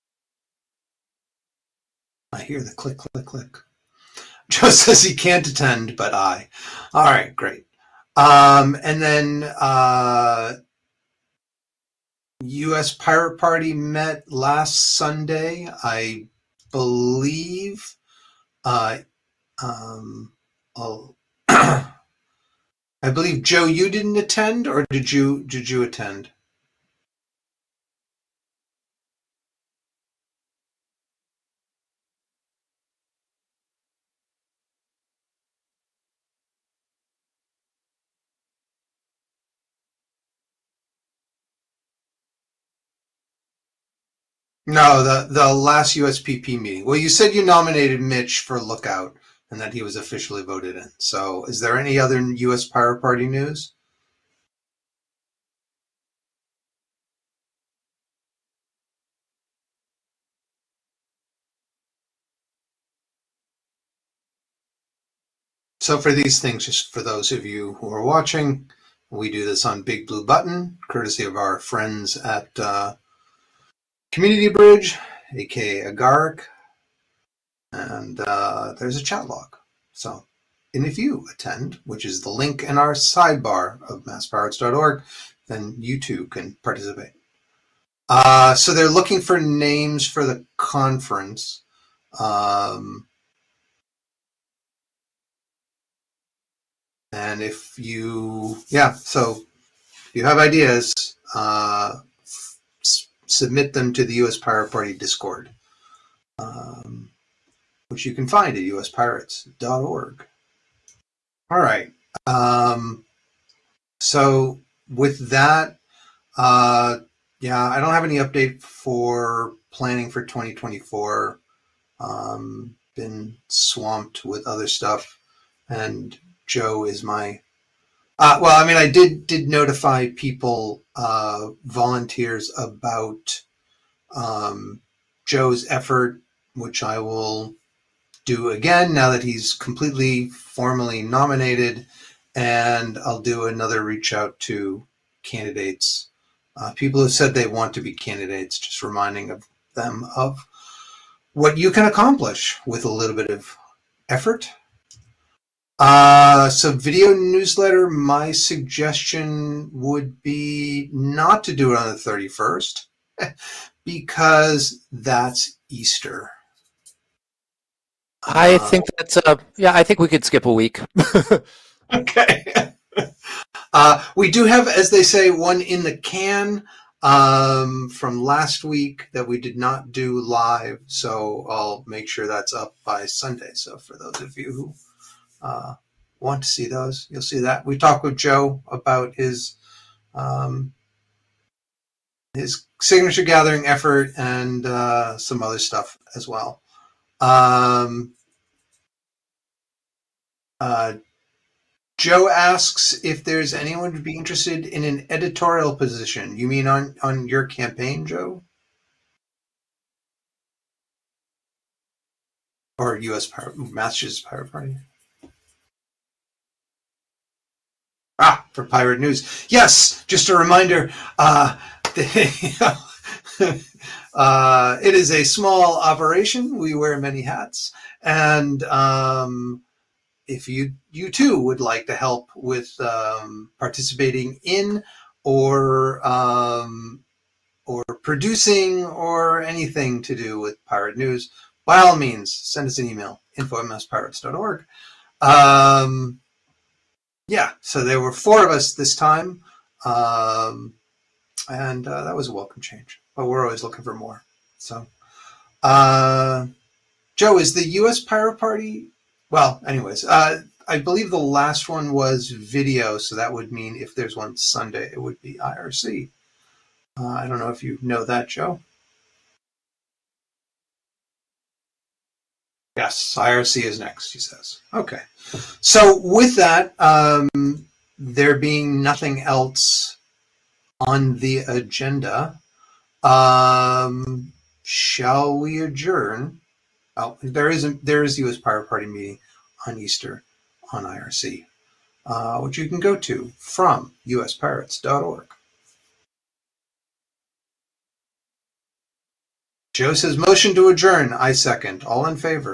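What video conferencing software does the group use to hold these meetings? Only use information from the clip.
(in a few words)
Big Blue Button.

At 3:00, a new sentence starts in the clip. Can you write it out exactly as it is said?
So I'll make sure that's up by Sunday.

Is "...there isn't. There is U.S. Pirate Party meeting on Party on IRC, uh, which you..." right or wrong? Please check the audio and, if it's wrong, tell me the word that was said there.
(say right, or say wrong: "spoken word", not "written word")
wrong: "Easter", not "Party".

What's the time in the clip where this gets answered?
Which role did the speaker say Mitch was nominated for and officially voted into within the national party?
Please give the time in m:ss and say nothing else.
0:48.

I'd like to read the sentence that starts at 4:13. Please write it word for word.
But we're always looking for more.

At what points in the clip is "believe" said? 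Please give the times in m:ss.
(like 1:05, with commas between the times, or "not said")
0:16, 0:23, 4:20.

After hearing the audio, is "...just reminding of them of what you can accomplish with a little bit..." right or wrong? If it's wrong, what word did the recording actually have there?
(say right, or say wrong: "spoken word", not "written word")
right.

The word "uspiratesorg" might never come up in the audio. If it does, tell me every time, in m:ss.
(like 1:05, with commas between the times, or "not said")
1:48, 4:54.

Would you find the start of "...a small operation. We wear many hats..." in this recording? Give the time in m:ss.
3:45.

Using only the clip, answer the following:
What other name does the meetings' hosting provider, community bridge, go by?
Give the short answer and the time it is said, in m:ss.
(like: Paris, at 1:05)
Agaric, at 1:15.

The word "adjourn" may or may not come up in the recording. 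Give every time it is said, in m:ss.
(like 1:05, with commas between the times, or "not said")
4:45, 5:00.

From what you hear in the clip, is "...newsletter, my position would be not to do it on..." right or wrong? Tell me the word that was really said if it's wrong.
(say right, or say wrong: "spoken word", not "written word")
wrong: "suggestion", not "position".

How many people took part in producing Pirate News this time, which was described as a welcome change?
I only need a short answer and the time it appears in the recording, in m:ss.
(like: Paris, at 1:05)
4, at 4:08.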